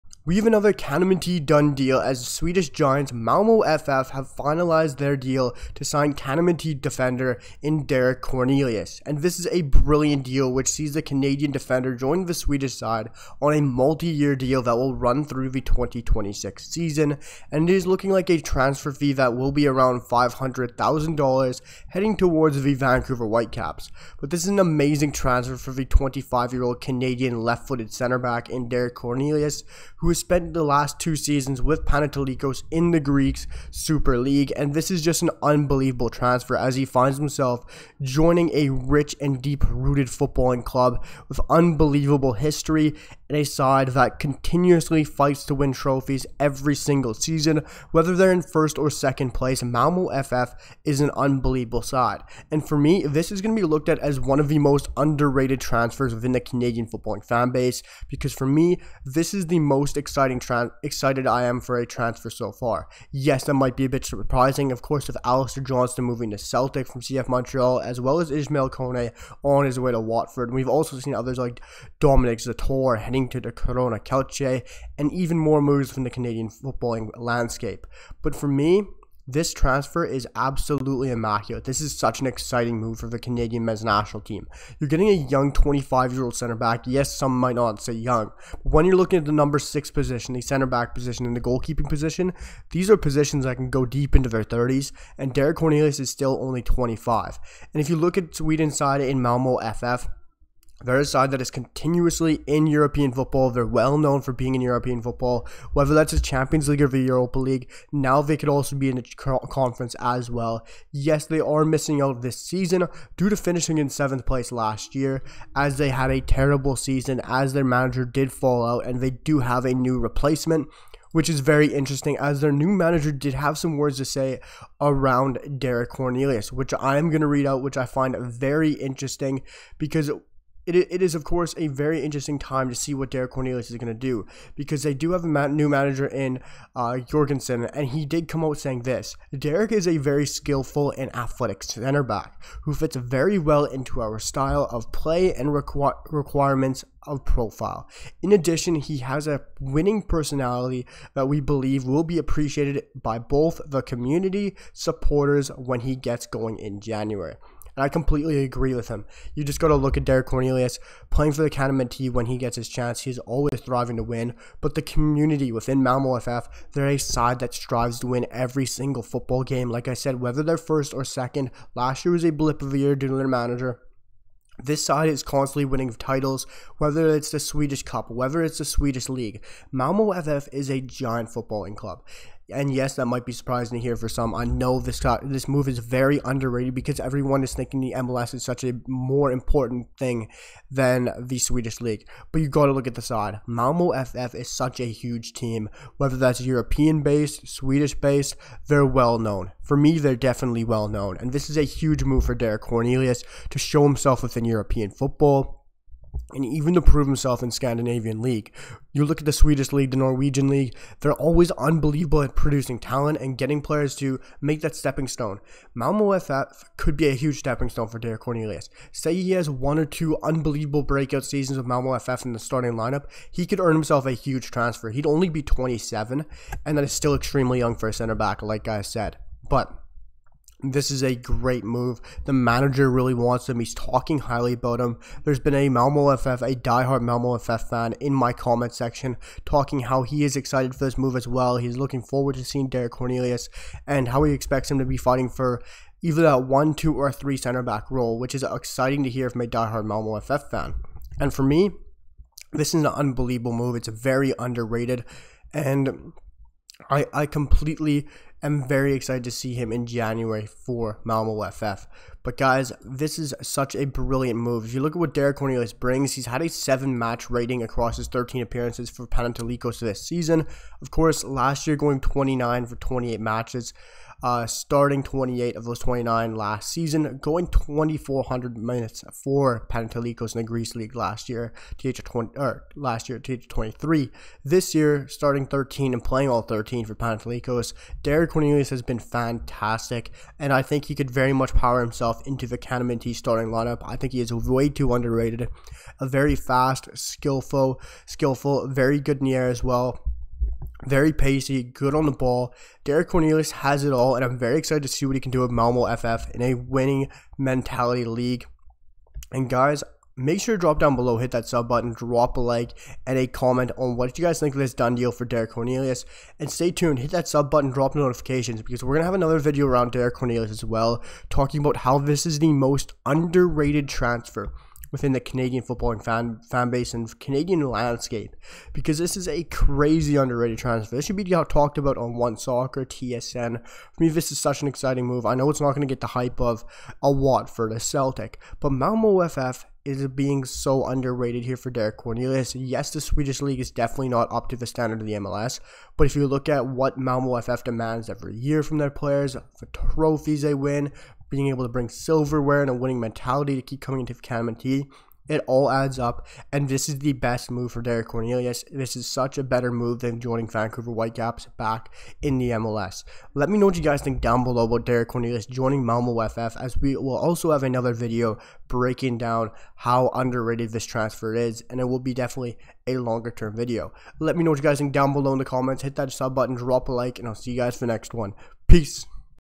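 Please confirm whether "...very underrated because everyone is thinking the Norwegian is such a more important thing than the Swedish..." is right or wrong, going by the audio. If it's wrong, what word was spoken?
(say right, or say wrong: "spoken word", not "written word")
wrong: "MLS", not "Norwegian".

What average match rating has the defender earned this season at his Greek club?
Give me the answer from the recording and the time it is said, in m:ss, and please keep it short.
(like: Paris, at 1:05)
7, at 4:26.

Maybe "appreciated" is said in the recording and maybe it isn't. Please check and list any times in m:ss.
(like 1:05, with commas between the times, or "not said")
2:32.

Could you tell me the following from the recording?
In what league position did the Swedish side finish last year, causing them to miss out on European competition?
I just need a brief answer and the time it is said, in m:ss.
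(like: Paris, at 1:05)
7th, at 1:53.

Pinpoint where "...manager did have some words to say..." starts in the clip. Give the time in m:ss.
2:02.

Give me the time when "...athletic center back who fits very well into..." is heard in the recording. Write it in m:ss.
2:21.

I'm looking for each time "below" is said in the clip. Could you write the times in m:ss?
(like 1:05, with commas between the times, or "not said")
5:10, 6:04, 6:15.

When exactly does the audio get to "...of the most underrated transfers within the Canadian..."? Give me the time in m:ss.
0:54.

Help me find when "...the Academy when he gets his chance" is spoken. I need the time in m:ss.
2:41.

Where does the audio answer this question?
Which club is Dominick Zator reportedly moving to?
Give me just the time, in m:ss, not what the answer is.
1:13.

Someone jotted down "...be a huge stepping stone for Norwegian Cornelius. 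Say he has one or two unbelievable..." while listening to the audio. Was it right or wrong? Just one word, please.
wrong.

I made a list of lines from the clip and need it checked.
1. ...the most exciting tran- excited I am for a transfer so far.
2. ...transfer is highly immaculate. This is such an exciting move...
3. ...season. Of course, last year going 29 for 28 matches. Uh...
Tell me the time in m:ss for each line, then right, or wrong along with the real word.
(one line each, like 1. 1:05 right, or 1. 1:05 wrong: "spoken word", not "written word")
1. 0:59 right
2. 1:19 wrong: "absolutely", not "highly"
3. 4:30 right.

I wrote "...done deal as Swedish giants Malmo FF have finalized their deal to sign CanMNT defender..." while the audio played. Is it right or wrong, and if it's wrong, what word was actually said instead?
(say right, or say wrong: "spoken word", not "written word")
right.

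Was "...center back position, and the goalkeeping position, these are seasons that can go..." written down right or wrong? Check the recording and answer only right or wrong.
wrong.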